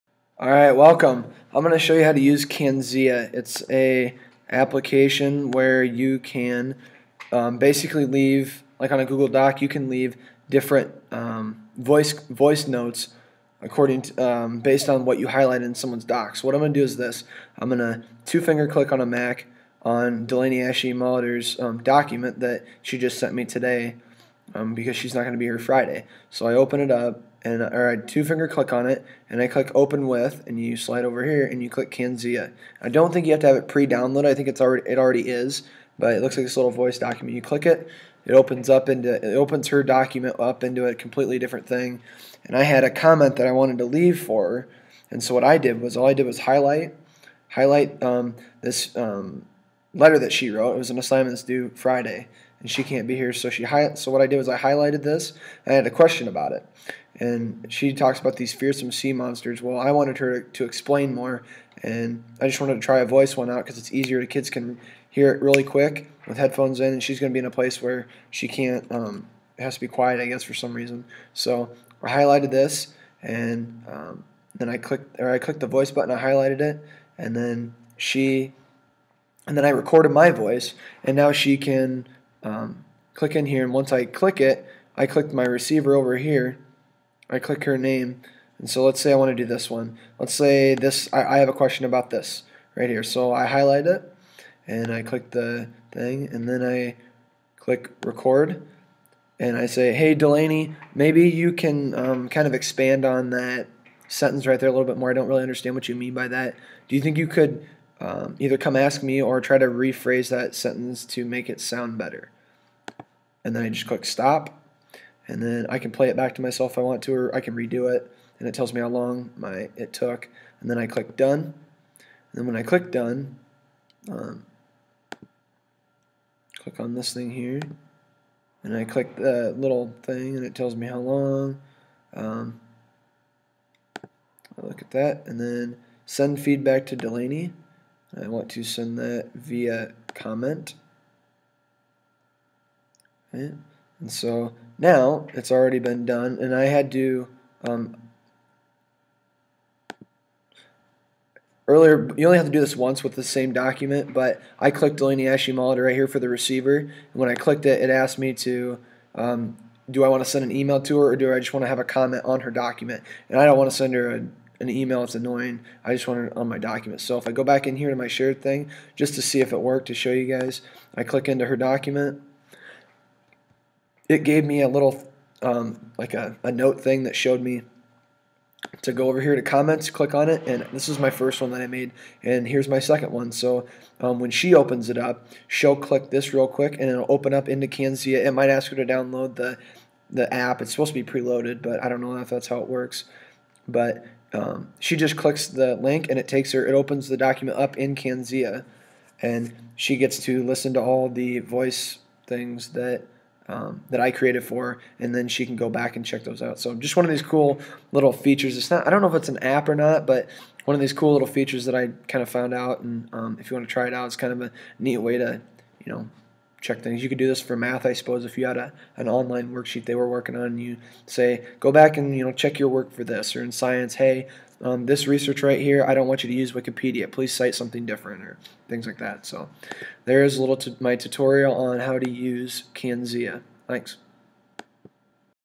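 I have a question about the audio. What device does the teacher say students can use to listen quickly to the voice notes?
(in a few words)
headphones.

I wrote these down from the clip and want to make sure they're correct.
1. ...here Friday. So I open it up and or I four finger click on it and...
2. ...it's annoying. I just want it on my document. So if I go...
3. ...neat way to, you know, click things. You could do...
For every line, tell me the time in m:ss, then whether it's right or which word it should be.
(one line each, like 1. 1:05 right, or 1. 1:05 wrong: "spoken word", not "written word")
1. 0:25 wrong: "two", not "four"
2. 2:45 right
3. 3:34 wrong: "check", not "click".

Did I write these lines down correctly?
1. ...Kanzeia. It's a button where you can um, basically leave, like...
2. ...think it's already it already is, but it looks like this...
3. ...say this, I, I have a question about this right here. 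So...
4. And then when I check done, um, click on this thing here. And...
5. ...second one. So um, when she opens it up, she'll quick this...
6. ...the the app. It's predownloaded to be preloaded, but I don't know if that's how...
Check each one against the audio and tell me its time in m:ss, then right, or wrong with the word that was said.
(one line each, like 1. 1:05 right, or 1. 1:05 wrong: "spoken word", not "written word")
1. 0:02 wrong: "application", not "button"
2. 0:34 right
3. 1:30 right
4. 2:01 wrong: "click", not "check"
5. 3:02 wrong: "click", not "quick"
6. 3:09 wrong: "supposed", not "predownloaded".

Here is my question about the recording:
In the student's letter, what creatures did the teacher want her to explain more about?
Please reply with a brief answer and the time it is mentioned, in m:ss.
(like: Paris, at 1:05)
fearsome sea monsters, at 0:58.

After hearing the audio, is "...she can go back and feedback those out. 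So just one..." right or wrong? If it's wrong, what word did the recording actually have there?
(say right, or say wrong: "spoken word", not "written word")
wrong: "check", not "feedback".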